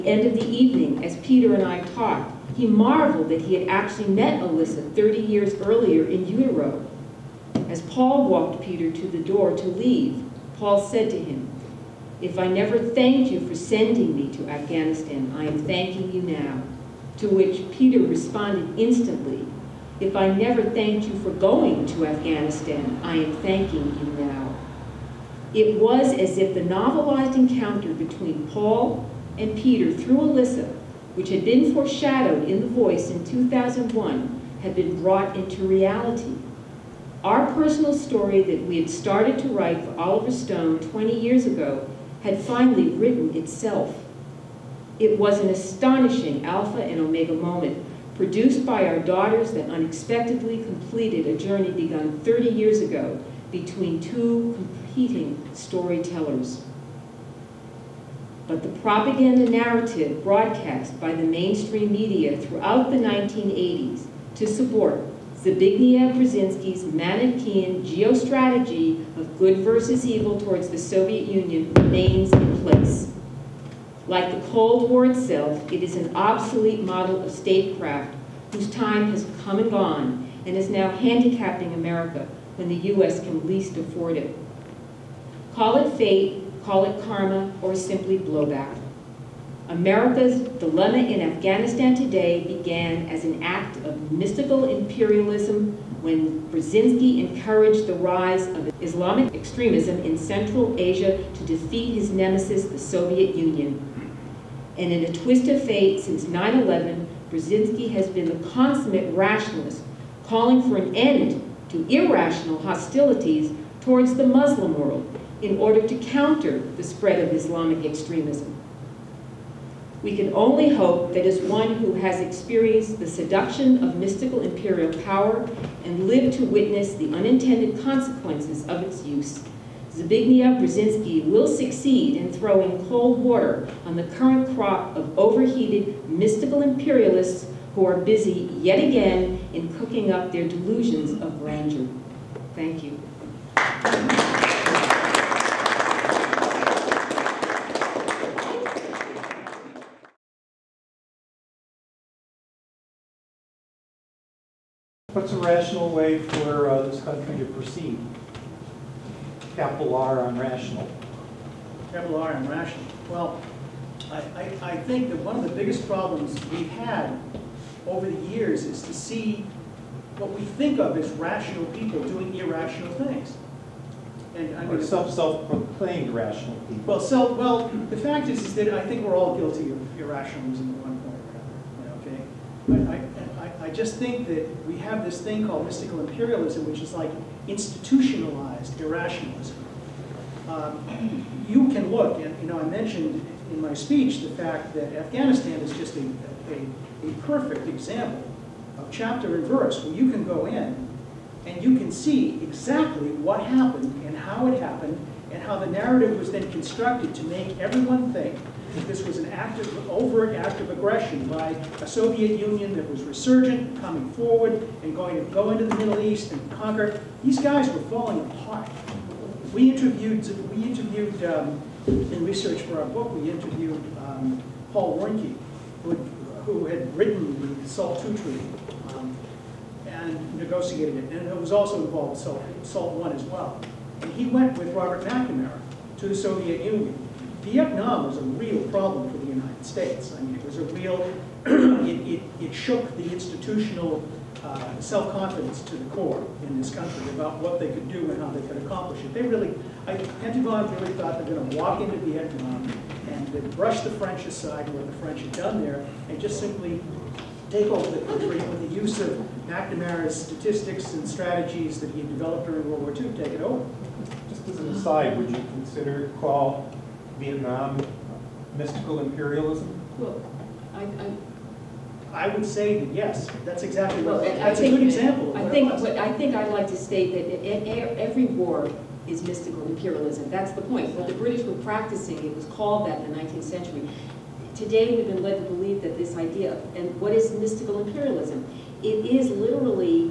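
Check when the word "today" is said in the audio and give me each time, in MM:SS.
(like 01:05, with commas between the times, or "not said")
01:31, 04:44.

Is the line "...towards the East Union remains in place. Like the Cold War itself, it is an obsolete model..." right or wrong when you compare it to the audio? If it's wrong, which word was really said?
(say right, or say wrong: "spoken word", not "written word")
wrong: "Soviet", not "East".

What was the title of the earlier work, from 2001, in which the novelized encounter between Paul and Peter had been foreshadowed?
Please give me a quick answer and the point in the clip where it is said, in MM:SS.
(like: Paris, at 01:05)
The Voice, at 00:32.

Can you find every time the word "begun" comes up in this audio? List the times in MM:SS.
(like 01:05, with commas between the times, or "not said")
00:51.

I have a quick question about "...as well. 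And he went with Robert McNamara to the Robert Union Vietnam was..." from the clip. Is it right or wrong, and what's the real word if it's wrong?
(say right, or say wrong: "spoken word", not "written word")
wrong: "Soviet", not "Robert".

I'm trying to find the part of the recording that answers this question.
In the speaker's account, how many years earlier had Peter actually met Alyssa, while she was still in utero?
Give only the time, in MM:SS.
00:04.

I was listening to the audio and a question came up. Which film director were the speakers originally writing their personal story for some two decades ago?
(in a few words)
Oliver Stone.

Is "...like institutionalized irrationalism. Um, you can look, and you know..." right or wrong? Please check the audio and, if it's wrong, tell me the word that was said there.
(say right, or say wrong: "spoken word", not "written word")
right.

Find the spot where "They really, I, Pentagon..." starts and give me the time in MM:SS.
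04:09.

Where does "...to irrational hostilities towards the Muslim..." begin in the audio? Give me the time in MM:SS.
01:51.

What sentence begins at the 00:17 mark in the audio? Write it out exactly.
To which Peter responded instantly, If I never thanked you for going to Afghanistan, I am thanking you now.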